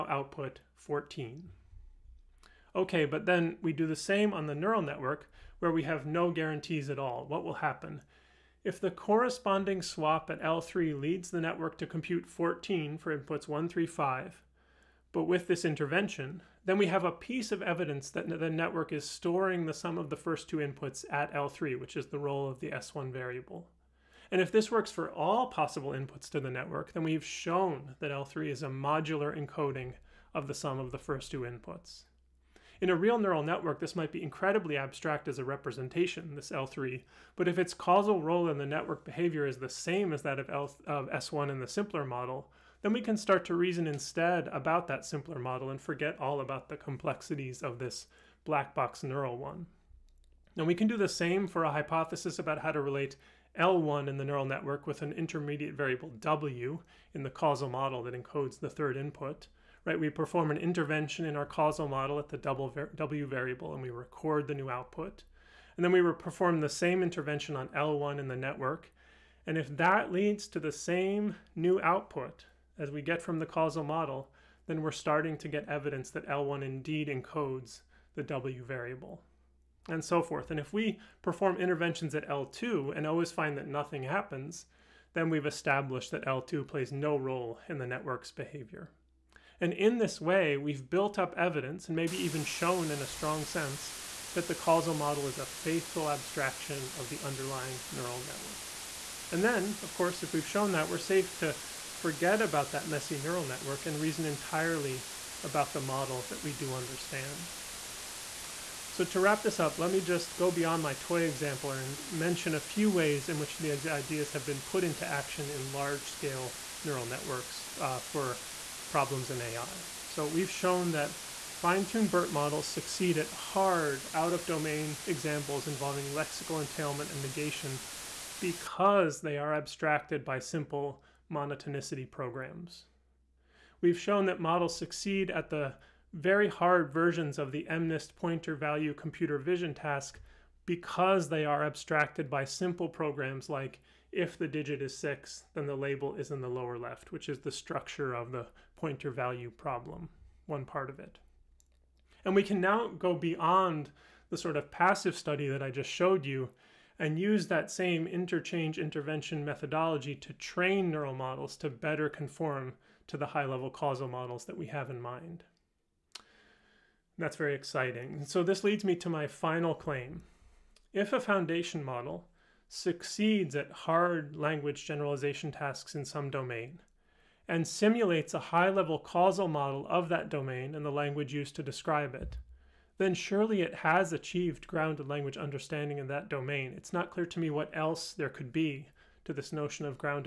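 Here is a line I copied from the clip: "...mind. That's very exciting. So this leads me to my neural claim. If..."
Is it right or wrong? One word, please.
wrong.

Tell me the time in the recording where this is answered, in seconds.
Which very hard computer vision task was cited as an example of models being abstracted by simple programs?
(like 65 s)
137 s.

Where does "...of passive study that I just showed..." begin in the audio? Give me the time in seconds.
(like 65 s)
154 s.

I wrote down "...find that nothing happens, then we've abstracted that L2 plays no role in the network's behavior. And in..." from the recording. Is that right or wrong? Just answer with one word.
wrong.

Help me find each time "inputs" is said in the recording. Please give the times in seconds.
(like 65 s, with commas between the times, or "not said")
13 s, 20 s, 25 s, 31 s, 58 s.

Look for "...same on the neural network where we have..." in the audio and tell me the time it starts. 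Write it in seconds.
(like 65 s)
3 s.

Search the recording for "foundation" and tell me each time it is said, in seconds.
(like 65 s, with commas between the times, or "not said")
171 s.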